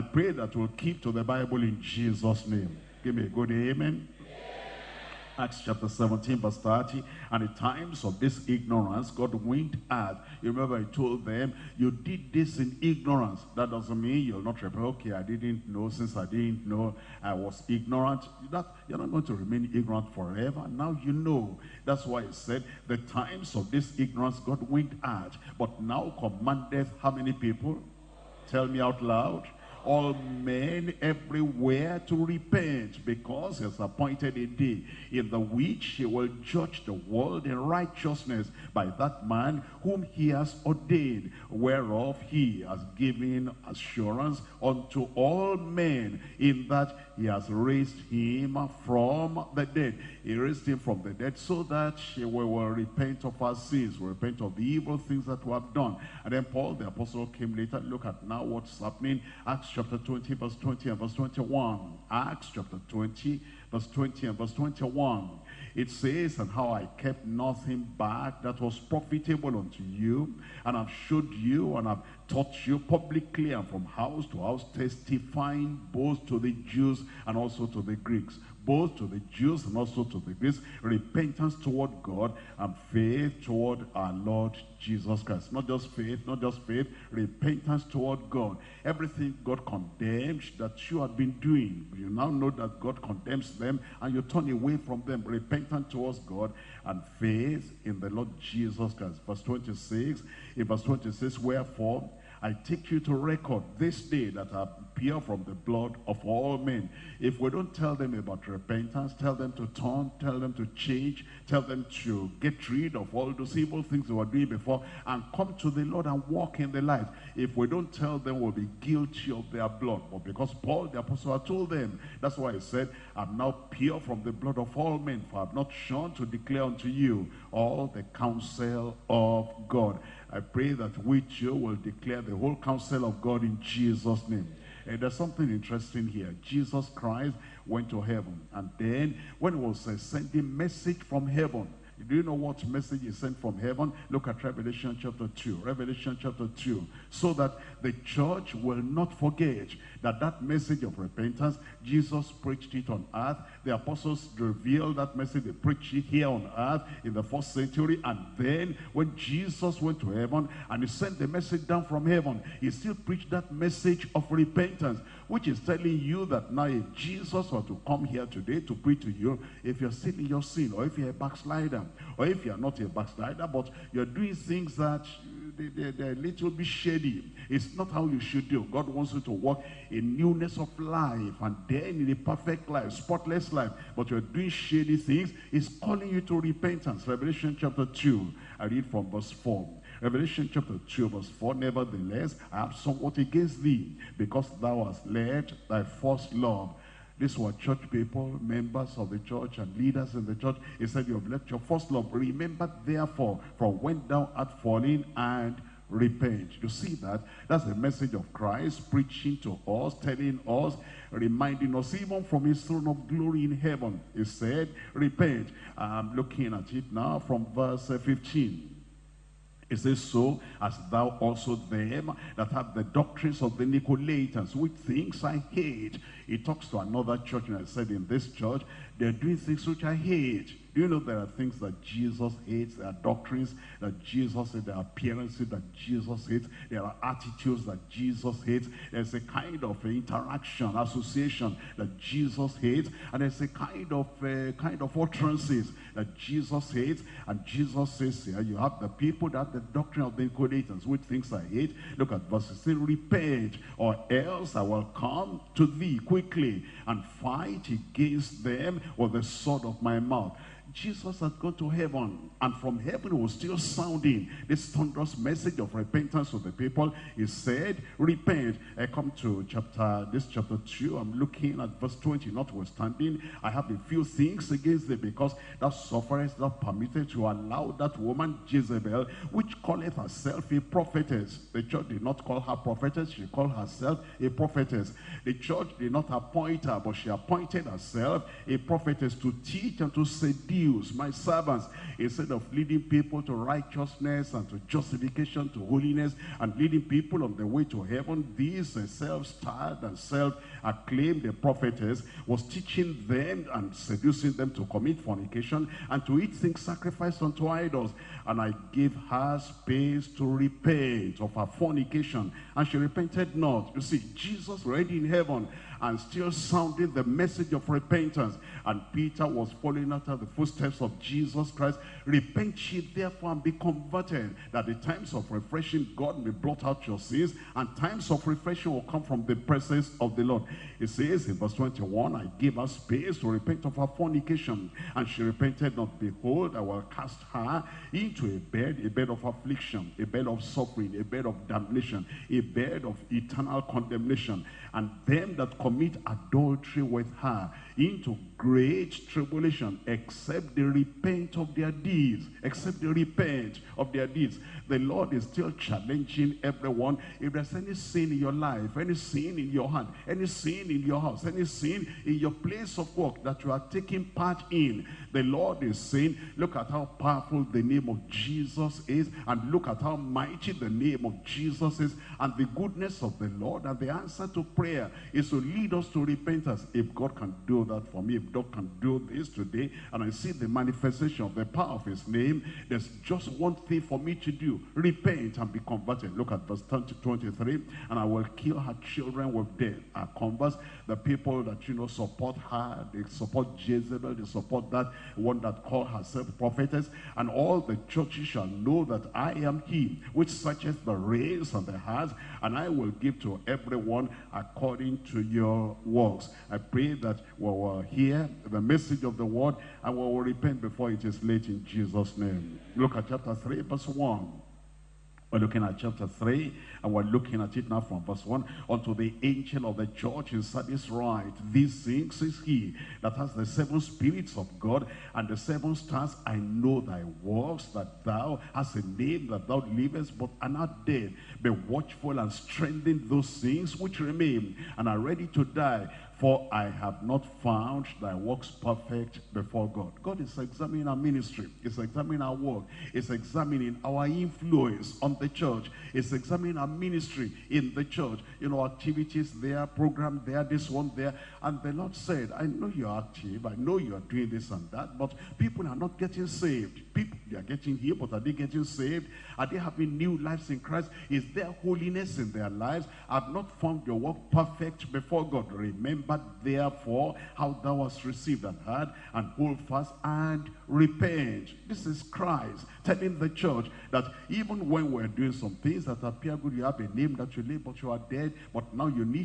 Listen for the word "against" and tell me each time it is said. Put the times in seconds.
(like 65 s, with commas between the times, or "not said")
193 s, 257 s, 274 s.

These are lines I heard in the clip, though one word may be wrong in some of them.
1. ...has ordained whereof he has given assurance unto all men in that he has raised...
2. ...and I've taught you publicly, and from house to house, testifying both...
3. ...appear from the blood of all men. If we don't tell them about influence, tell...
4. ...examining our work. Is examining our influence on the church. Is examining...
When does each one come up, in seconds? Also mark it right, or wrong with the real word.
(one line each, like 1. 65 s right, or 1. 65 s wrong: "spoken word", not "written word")
1. 40 s right
2. 71 s right
3. 104 s wrong: "repentance", not "influence"
4. 441 s right.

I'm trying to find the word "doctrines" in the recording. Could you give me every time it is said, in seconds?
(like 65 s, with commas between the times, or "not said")
222 s, 232 s, 249 s.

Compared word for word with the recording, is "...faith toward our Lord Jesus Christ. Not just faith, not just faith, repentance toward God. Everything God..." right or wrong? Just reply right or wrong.
right.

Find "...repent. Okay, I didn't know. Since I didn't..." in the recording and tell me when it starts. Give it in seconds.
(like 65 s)
14 s.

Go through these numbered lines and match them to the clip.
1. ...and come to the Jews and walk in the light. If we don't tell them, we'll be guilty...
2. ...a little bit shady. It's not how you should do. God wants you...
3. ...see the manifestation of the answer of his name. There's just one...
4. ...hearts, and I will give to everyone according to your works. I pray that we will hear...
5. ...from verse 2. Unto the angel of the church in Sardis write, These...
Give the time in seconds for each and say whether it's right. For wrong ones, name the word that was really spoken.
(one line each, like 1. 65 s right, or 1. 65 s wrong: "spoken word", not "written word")
1. 115 s wrong: "Lord", not "Jews"
2. 176 s right
3. 380 s wrong: "power", not "answer"
4. 401 s right
5. 417 s wrong: "1", not "2".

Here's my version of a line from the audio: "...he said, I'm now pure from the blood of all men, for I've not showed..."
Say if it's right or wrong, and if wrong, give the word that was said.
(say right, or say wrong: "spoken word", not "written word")
wrong: "shunned", not "showed".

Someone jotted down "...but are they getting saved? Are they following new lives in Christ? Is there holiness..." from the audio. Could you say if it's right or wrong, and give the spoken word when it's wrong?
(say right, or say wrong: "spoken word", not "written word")
wrong: "having", not "following".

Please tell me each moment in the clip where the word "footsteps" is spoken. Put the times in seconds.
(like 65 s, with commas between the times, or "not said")
320 s.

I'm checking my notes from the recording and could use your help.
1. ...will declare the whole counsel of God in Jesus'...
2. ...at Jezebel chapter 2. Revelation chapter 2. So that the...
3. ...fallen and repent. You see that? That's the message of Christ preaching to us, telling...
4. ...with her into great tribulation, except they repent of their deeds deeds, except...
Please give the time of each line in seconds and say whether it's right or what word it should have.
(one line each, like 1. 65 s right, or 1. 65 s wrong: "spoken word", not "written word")
1. 131 s right
2. 144 s wrong: "Revelation", not "Jezebel"
3. 204 s right
4. 346 s right.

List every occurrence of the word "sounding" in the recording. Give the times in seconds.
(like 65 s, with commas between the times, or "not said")
263 s, 316 s.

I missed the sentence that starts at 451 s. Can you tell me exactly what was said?
And the Lord said, I know you're active.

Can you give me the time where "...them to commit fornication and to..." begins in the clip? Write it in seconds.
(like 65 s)
304 s.